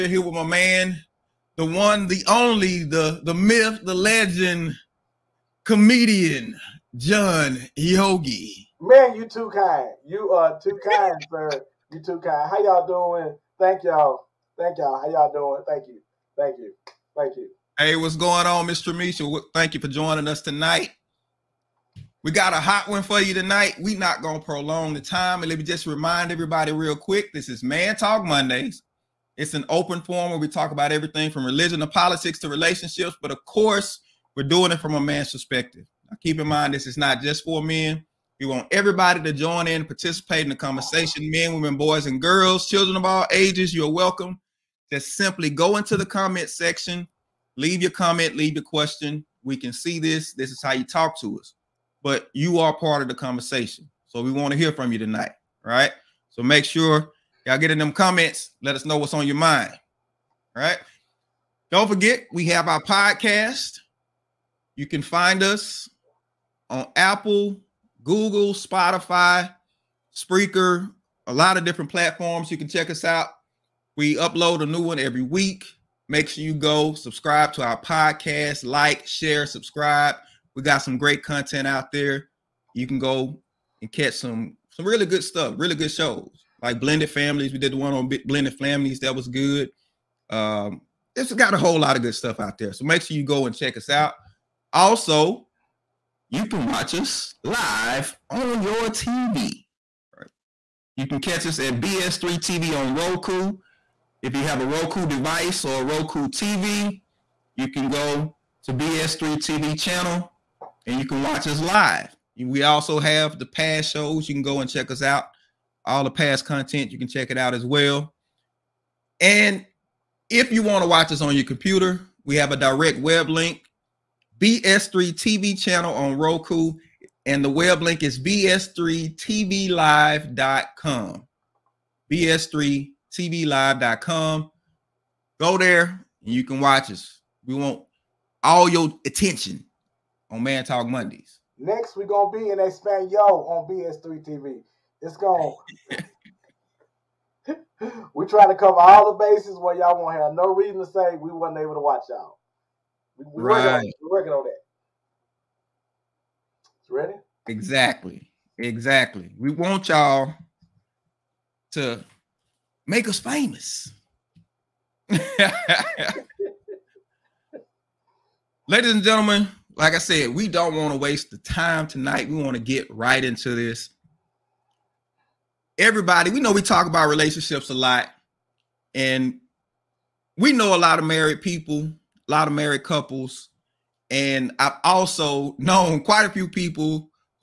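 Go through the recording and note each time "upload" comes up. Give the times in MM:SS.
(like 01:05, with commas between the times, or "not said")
01:14.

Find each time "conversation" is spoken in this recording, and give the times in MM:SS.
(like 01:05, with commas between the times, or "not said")
00:40, 00:53.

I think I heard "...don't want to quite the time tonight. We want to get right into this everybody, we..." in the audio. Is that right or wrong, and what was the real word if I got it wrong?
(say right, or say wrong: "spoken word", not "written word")
wrong: "waste", not "quite".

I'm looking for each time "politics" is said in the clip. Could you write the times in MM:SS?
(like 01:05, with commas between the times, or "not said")
00:31.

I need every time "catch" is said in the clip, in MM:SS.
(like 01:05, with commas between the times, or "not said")
01:23, 01:41.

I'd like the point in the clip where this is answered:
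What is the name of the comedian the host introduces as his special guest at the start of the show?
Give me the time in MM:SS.
00:06.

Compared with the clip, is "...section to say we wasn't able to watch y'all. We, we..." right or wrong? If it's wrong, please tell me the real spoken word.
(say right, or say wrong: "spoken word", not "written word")
wrong: "reason", not "section".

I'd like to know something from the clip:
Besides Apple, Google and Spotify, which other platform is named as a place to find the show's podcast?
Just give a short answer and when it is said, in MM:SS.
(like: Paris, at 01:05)
Spreaker, at 01:10.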